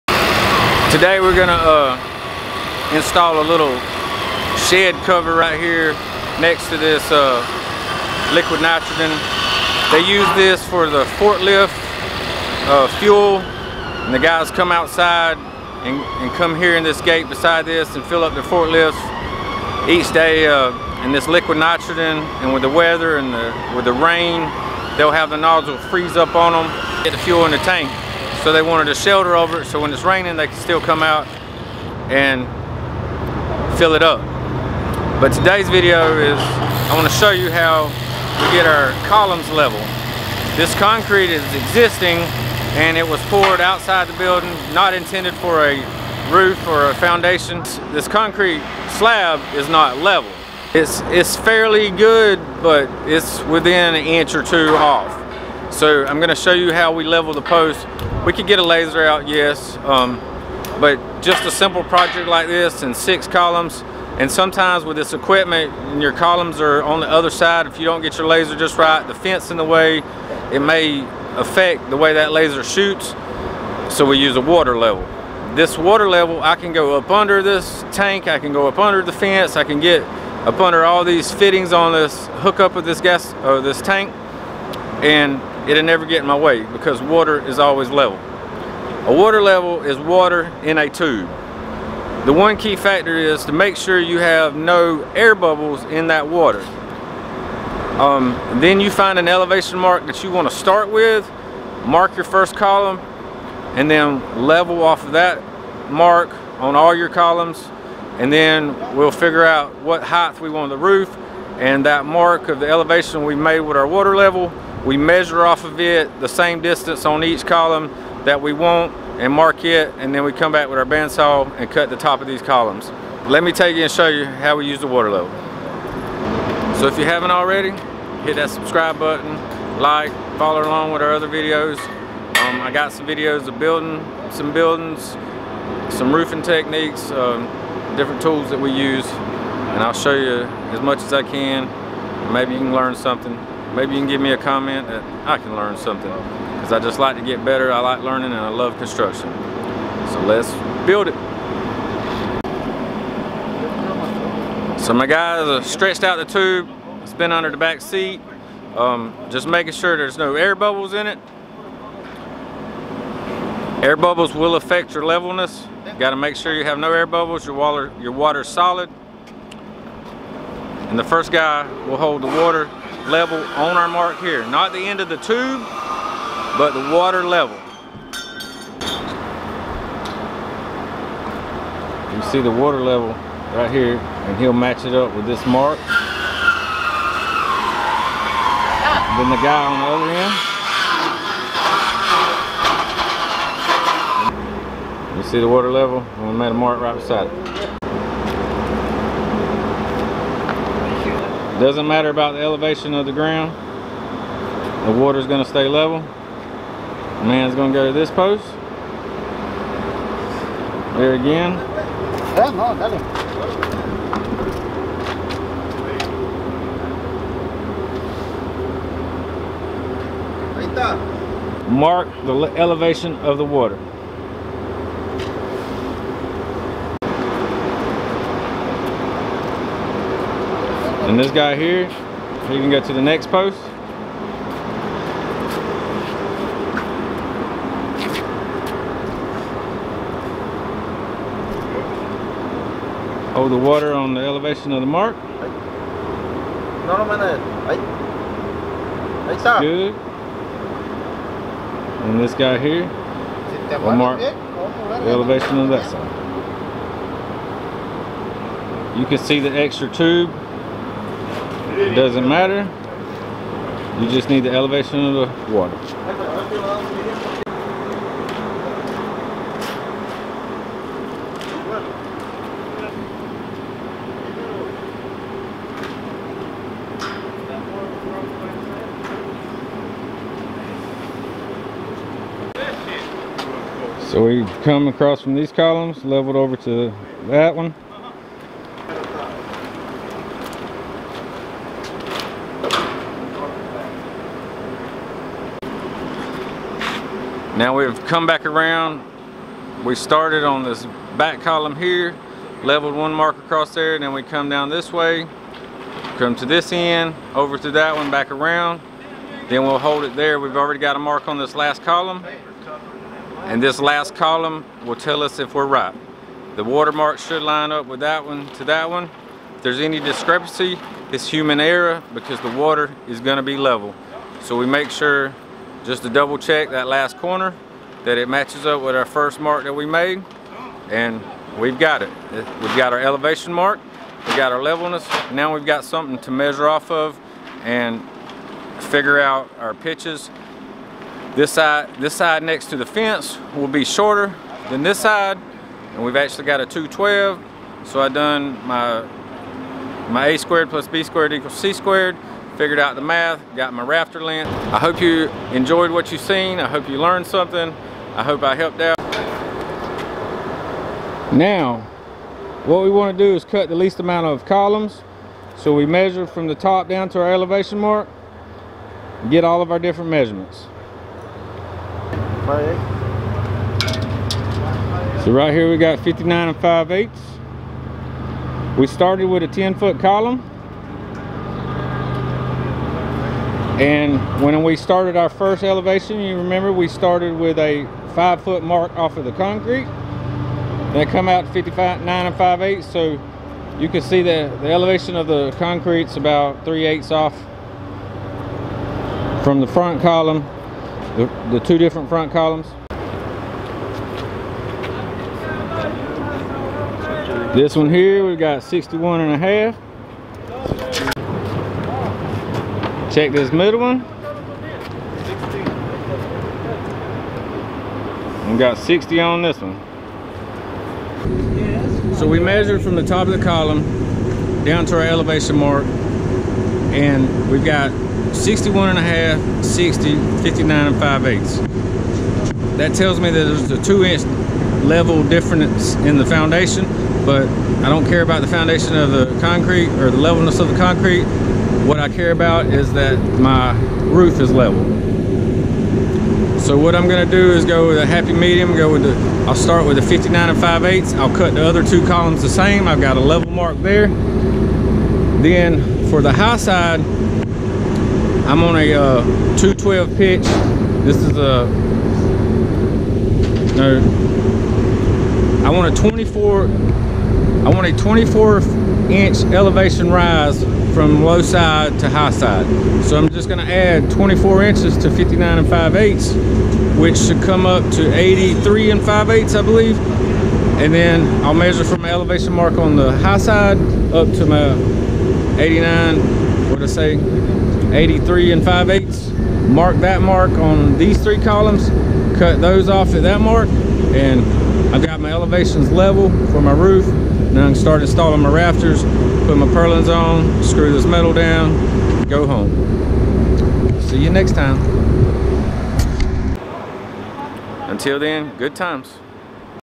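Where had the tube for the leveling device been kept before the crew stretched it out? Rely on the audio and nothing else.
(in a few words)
under the back seat.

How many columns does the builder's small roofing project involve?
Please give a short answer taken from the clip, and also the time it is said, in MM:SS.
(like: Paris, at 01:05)
6, at 01:02.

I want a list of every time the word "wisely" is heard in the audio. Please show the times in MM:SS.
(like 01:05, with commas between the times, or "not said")
not said.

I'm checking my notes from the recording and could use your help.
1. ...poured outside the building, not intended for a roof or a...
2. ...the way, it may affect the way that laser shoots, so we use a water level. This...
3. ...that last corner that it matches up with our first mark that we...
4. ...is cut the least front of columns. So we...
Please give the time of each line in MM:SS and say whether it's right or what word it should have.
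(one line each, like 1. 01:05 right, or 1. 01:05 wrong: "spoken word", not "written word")
1. 00:43 right
2. 01:09 right
3. 05:26 right
4. 06:03 wrong: "amount", not "front".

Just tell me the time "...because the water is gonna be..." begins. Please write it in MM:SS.
05:22.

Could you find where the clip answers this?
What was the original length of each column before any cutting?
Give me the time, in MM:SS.
06:19.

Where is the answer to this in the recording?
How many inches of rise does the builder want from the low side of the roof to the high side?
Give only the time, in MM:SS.
07:47.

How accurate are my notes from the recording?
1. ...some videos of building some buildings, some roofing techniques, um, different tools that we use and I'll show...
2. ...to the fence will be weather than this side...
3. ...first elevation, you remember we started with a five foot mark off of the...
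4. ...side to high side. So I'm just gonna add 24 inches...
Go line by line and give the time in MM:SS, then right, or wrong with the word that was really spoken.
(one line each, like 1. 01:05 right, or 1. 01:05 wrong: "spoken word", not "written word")
1. 02:12 right
2. 05:42 wrong: "shorter", not "weather"
3. 06:25 right
4. 07:51 right.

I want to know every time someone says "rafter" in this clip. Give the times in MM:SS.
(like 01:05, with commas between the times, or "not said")
05:53, 08:18.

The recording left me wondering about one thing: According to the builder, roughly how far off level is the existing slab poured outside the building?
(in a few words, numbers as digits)
an inch or two.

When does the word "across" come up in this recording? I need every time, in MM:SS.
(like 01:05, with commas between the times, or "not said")
04:44, 05:03.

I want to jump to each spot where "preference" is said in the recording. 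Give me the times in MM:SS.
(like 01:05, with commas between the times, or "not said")
not said.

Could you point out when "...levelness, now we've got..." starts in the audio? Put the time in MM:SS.
05:34.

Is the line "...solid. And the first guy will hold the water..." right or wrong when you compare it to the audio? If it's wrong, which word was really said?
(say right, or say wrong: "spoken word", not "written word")
right.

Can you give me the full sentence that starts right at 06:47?
This one here, we've got 61 and a half.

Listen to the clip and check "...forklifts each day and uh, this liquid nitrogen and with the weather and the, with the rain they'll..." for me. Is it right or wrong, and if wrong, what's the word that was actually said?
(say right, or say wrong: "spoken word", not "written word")
right.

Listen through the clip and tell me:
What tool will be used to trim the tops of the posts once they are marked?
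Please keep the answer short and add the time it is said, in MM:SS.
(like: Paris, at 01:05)
bandsaw, at 02:00.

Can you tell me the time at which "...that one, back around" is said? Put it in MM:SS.
05:07.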